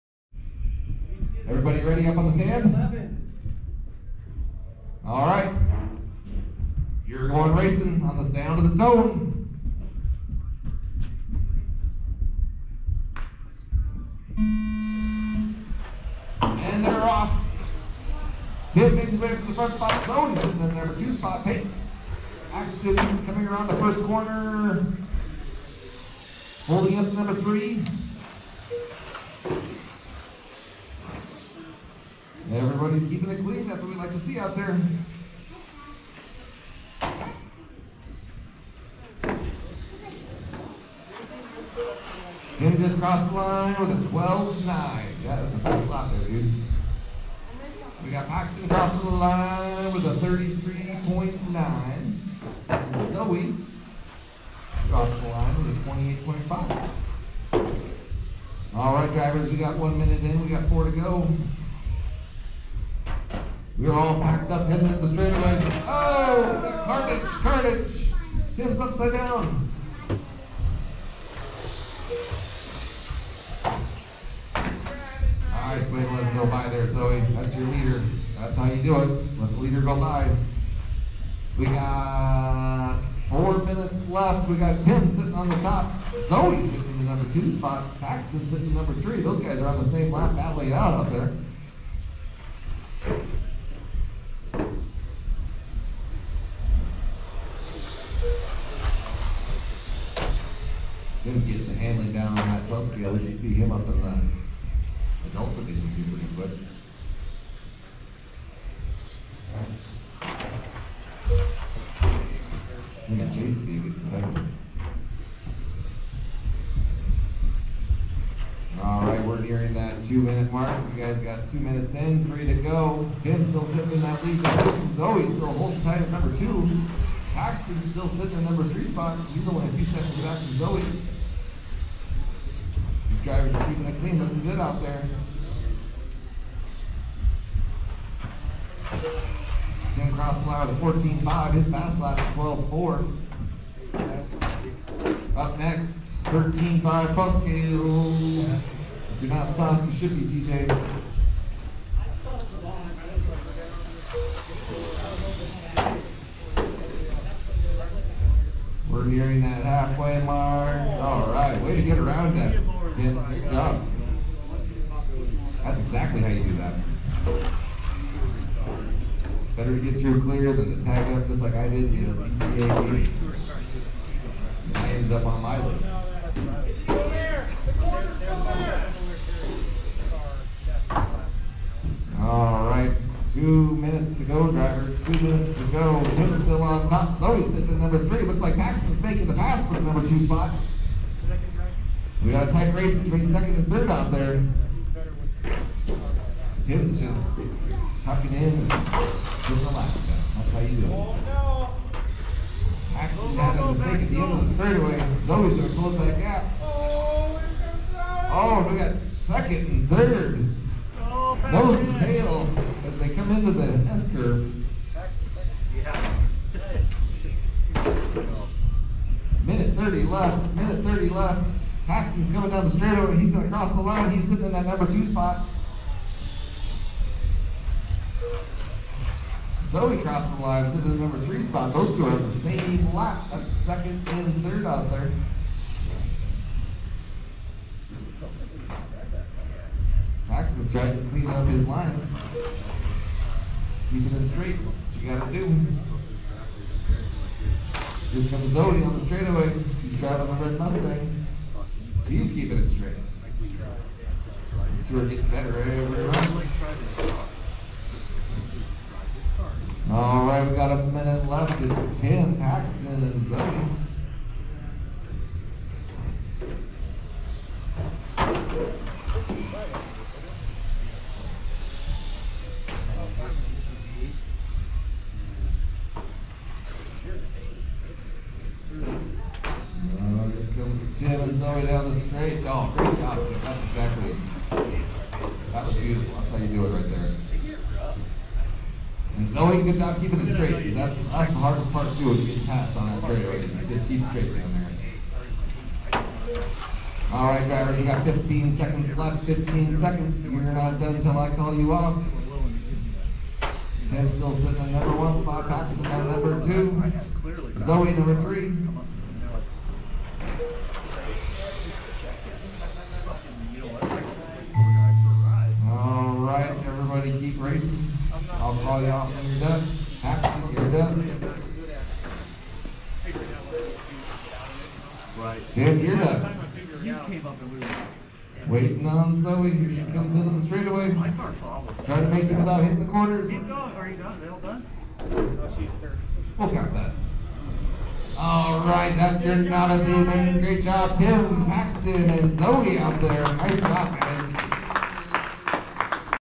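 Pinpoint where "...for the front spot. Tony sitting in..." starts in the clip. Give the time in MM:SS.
00:19.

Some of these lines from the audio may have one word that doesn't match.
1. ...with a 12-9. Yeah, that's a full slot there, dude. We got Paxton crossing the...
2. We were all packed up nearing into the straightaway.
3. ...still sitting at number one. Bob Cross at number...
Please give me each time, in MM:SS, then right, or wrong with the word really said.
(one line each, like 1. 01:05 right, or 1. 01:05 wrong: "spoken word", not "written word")
1. 00:43 right
2. 01:03 wrong: "heading", not "nearing"
3. 05:04 wrong: "Paxton", not "Cross".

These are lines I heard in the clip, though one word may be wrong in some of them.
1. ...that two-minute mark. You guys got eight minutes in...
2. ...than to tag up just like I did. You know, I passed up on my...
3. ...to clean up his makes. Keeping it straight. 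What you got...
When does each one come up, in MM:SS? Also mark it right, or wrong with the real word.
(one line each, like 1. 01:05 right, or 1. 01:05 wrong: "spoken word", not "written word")
1. 01:59 wrong: "two", not "eight"
2. 02:50 wrong: "ended", not "passed"
3. 04:01 wrong: "lines", not "makes".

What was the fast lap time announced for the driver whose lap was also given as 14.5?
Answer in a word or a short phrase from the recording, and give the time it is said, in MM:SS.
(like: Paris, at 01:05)
12.4, at 02:22.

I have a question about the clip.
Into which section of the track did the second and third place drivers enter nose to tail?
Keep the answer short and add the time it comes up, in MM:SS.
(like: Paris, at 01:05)
S curve, at 03:33.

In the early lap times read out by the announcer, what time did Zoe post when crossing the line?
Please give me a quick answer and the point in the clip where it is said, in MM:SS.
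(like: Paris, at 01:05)
28.5, at 00:55.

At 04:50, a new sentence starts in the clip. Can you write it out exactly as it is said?
that's, that's the hardest part too, is getting passed on that straight Right?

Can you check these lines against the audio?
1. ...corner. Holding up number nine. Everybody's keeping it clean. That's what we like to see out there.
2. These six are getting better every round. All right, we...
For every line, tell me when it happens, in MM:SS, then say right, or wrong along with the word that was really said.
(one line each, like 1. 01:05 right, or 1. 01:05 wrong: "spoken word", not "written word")
1. 00:24 wrong: "three", not "nine"
2. 04:13 wrong: "two", not "six".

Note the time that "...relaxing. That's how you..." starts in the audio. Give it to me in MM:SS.
03:19.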